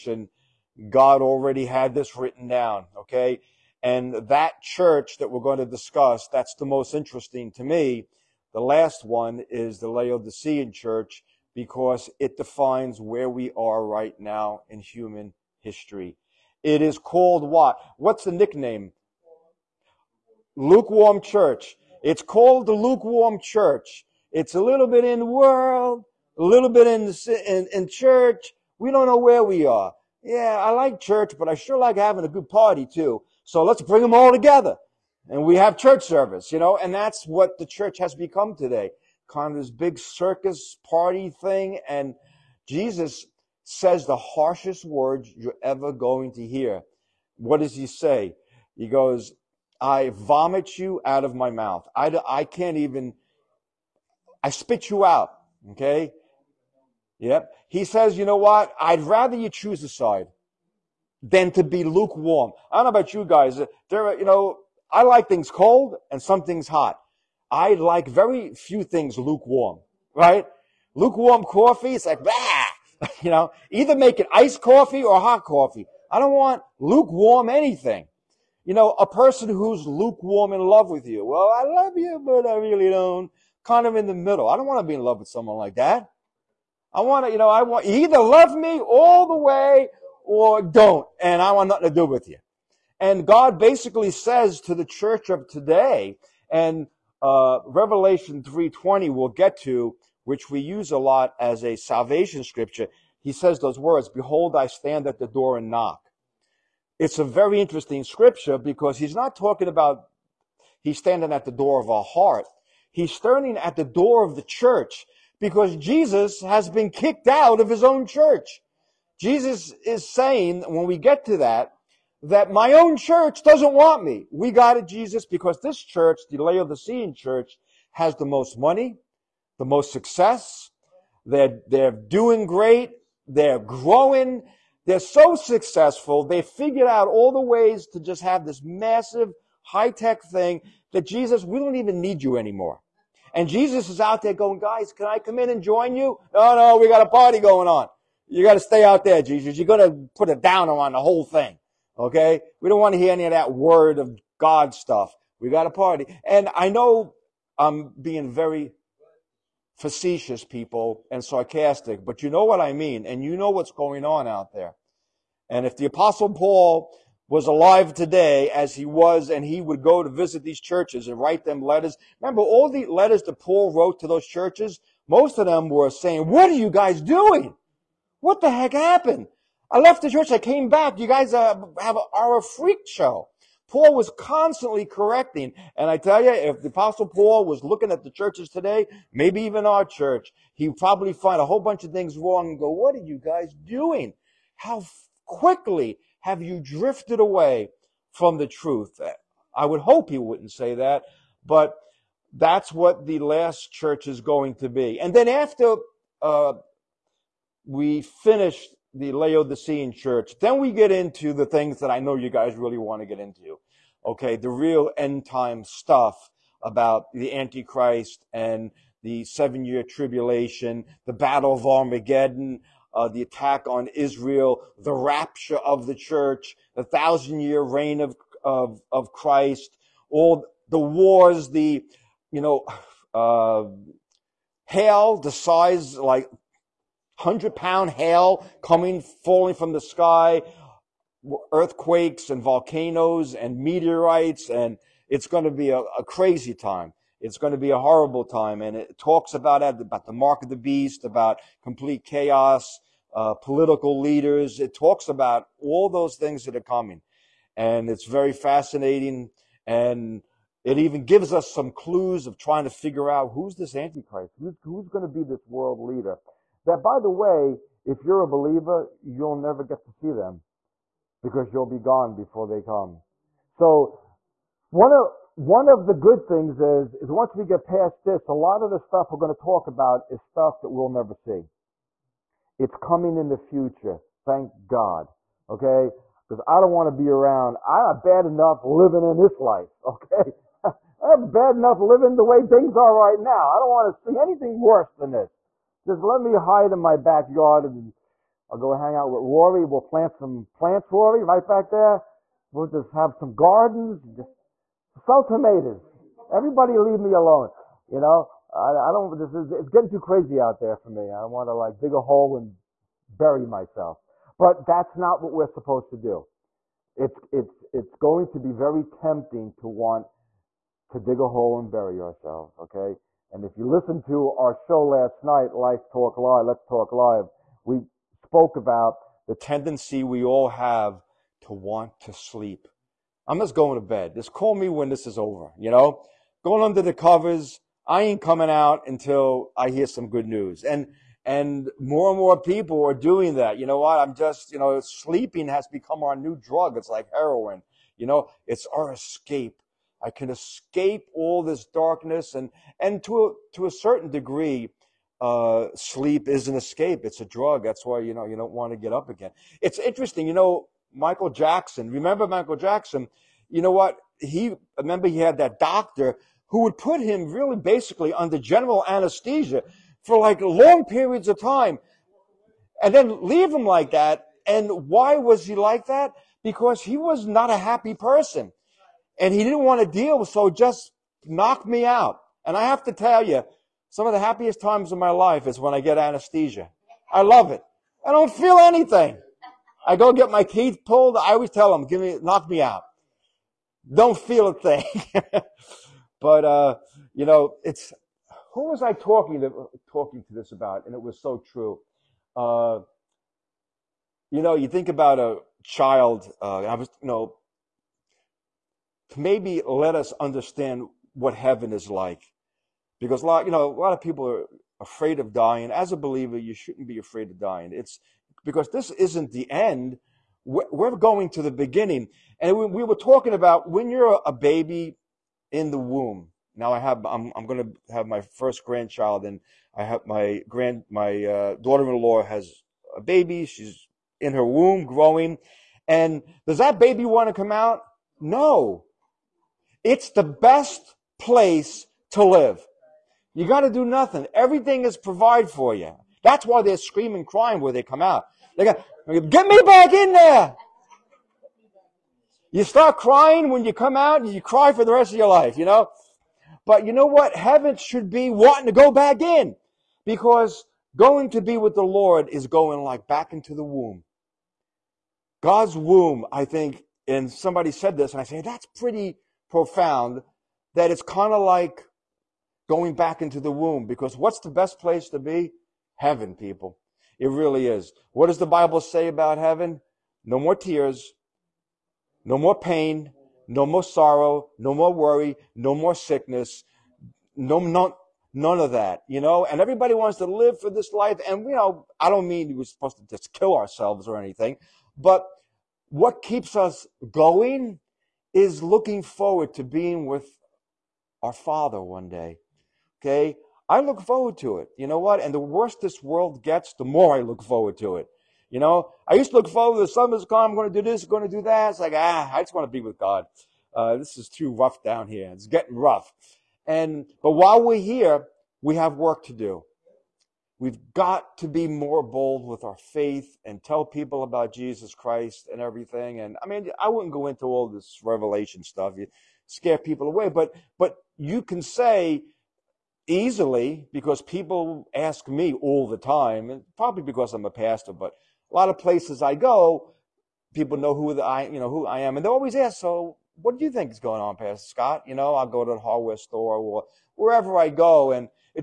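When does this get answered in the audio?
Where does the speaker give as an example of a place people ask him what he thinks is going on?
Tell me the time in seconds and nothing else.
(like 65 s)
545 s.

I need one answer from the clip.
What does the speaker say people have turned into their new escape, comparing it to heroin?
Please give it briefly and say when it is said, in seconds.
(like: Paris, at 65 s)
Sleeping, at 344 s.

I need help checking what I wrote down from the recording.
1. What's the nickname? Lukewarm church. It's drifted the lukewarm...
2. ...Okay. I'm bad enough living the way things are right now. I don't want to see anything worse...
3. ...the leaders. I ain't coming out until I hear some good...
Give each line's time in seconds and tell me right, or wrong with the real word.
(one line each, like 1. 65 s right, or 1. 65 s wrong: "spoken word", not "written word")
1. 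17 s wrong: "called", not "drifted"
2. 289 s right
3. 336 s wrong: "covers", not "leaders".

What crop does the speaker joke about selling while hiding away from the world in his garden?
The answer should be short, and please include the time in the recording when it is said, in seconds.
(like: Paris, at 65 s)
Tomatoes, at 305 s.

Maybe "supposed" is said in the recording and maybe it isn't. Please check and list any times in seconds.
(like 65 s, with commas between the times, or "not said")
315 s, 492 s.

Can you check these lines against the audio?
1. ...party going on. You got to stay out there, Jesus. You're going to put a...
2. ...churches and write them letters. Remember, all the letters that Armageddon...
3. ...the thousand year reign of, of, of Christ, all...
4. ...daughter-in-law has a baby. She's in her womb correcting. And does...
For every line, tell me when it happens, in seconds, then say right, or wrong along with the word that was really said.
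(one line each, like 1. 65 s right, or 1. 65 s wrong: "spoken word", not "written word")
1. 147 s right
2. 170 s wrong: "Paul", not "Armageddon"
3. 226 s right
4. 431 s wrong: "growing", not "correcting".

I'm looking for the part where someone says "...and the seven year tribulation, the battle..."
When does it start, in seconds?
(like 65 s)
218 s.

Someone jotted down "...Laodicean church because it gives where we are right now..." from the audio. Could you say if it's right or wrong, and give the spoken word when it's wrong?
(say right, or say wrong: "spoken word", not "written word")
wrong: "defines", not "gives".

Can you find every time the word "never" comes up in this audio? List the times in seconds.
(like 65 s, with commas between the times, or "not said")
269 s, 280 s.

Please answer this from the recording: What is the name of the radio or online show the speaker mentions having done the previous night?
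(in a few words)
Life Talk Live.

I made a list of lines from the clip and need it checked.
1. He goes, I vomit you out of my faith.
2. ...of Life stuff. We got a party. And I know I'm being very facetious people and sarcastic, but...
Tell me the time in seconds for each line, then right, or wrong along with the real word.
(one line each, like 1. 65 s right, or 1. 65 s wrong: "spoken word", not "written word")
1. 48 s wrong: "mouth", not "faith"
2. 153 s wrong: "God", not "Life".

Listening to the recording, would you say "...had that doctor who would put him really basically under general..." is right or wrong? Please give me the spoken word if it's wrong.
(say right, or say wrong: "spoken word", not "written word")
right.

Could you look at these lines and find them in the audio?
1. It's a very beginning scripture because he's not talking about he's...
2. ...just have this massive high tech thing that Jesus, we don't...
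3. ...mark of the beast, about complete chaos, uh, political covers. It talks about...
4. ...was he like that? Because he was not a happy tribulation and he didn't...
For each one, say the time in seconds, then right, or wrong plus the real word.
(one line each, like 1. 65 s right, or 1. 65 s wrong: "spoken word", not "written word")
1. 106 s wrong: "interesting", not "beginning"
2. 137 s right
3. 250 s wrong: "leaders", not "covers"
4. 375 s wrong: "person", not "tribulation".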